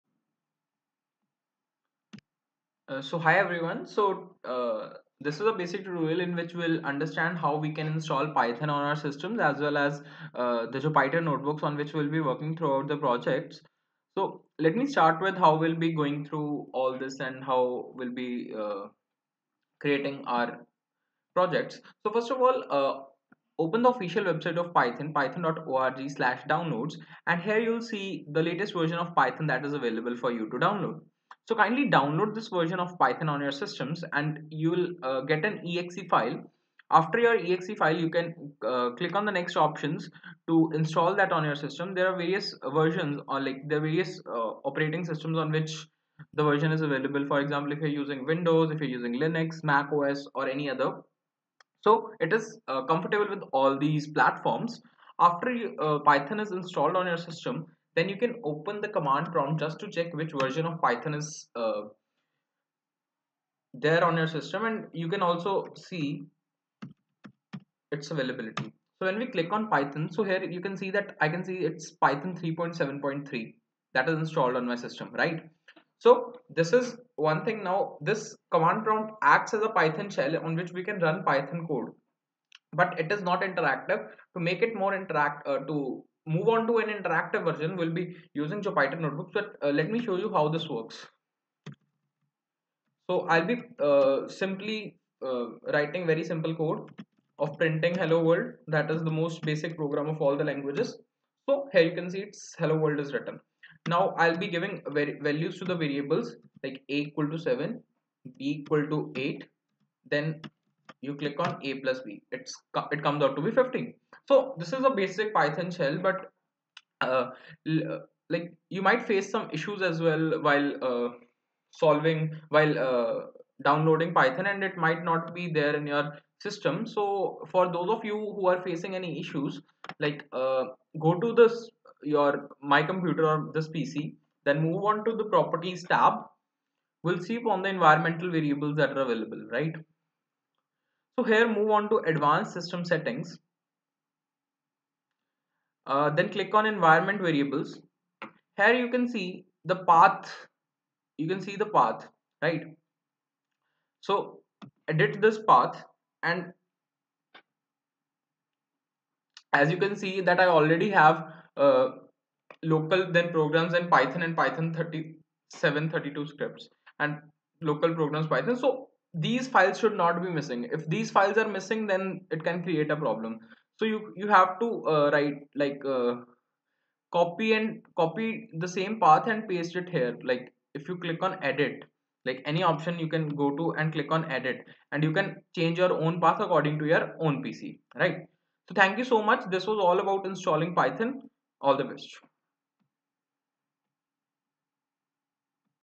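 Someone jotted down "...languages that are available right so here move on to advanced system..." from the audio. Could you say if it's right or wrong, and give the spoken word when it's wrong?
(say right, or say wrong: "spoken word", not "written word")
wrong: "variables", not "languages".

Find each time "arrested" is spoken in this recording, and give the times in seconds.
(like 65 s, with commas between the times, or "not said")
not said.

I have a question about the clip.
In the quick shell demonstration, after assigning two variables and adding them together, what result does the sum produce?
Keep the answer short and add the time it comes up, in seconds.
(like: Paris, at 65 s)
15, at 113 s.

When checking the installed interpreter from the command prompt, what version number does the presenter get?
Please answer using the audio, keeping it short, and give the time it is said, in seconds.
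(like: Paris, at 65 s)
3.7.3, at 72 s.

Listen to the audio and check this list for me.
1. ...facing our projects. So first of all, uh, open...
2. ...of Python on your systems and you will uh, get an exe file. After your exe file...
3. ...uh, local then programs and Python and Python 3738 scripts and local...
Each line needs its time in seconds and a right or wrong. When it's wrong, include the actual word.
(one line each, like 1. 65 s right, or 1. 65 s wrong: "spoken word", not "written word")
1. 19 s wrong: "creating", not "facing"
2. 32 s right
3. 161 s wrong: "3732", not "3738".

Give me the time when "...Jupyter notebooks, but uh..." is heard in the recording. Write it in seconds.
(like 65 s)
88 s.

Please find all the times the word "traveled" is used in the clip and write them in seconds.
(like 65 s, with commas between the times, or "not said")
not said.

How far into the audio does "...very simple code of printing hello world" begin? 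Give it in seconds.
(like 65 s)
96 s.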